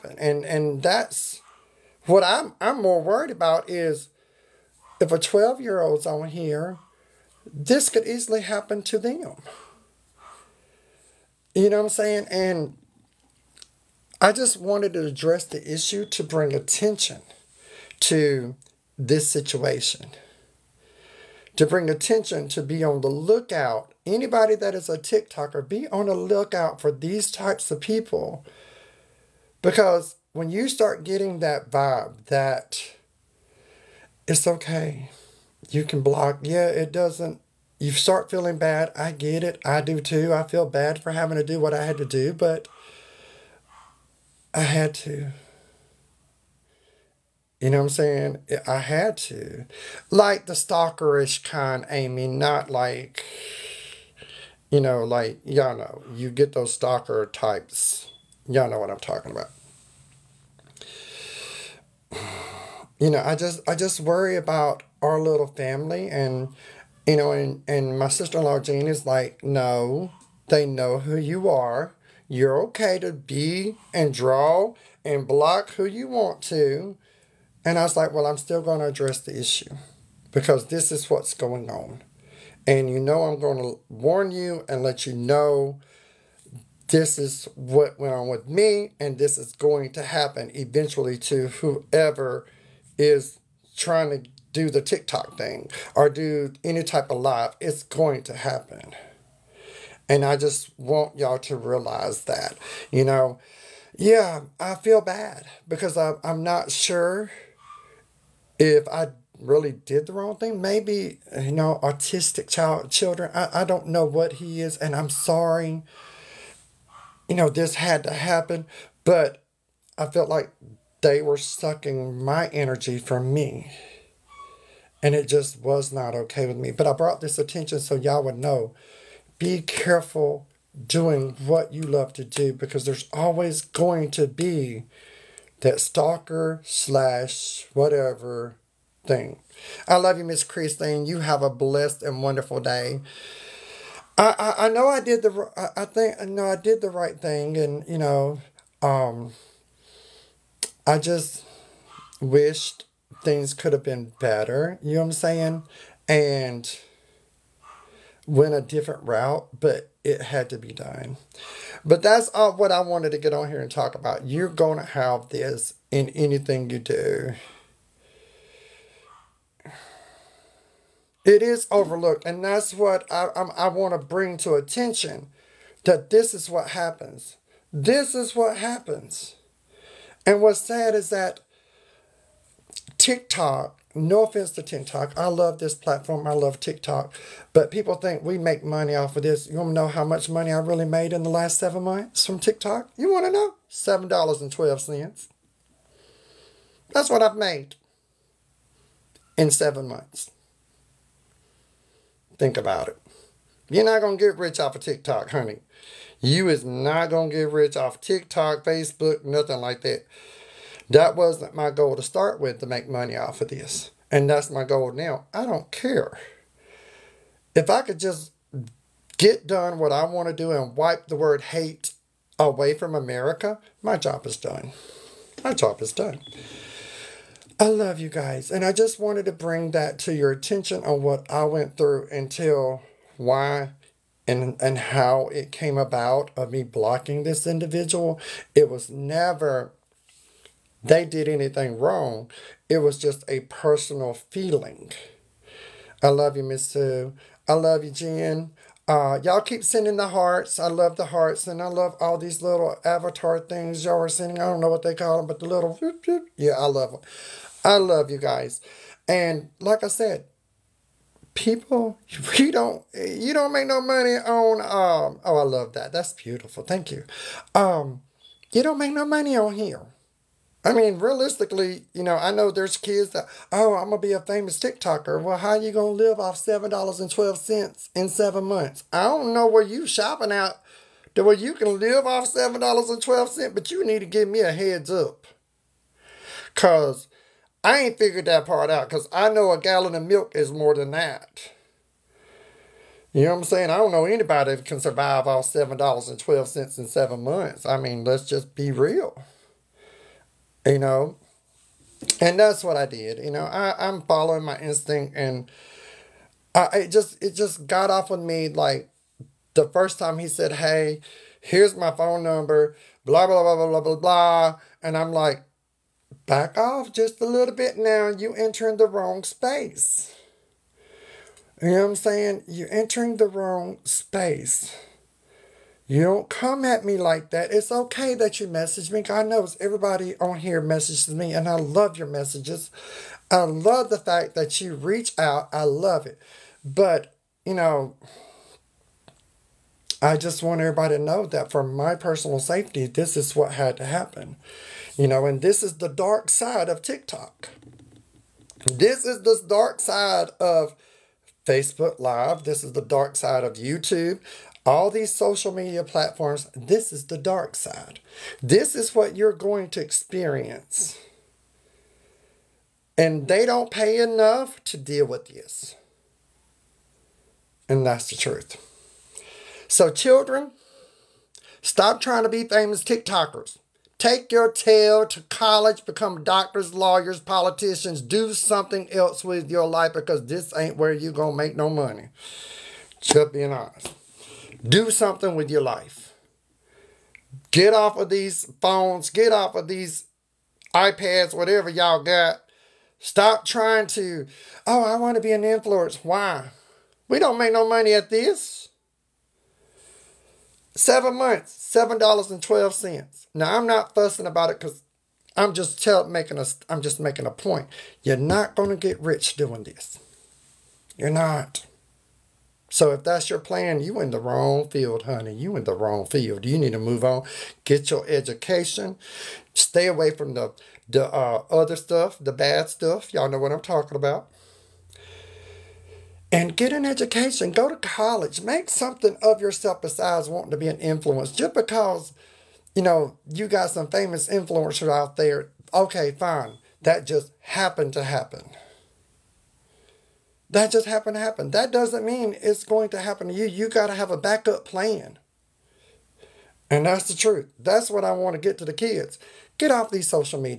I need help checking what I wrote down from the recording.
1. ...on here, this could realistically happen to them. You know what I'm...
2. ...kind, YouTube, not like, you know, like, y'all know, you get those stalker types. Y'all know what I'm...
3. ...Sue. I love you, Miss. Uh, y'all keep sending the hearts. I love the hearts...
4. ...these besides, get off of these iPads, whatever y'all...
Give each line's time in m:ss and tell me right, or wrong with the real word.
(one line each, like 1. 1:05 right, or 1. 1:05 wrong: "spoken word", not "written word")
1. 0:06 wrong: "easily", not "realistically"
2. 0:51 wrong: "Amy", not "YouTube"
3. 4:06 wrong: "Jen", not "Miss"
4. 6:28 wrong: "phones", not "besides".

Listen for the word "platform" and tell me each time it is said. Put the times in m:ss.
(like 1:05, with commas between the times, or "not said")
3:05, 5:55.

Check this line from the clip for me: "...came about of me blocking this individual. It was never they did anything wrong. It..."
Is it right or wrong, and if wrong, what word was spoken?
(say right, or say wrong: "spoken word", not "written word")
right.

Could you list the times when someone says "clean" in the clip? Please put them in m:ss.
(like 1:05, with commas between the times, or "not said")
not said.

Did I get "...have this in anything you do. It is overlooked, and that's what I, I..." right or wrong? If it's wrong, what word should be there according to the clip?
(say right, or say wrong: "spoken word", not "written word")
right.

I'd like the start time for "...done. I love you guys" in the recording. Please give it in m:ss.
3:45.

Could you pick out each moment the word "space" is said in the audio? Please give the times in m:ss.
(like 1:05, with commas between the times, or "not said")
5:19, 5:23.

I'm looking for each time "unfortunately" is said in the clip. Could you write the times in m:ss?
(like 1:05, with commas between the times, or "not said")
not said.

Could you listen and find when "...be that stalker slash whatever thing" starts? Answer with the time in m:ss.
2:14.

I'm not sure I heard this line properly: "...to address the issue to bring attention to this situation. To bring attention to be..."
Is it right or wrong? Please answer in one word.
right.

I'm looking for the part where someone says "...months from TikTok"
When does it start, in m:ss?
3:11.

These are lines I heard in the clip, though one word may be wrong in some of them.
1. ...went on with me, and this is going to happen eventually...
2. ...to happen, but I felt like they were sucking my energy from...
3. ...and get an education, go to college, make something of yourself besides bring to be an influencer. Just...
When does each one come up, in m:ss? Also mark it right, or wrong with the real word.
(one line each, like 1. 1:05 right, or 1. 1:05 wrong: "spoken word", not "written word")
1. 1:27 right
2. 1:58 right
3. 7:06 wrong: "wanting", not "bring".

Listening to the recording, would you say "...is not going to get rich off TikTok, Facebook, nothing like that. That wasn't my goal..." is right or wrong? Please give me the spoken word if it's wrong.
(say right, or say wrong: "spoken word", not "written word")
right.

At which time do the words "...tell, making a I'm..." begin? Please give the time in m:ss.
6:45.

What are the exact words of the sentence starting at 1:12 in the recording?
You're okay to be and draw and block who you want to.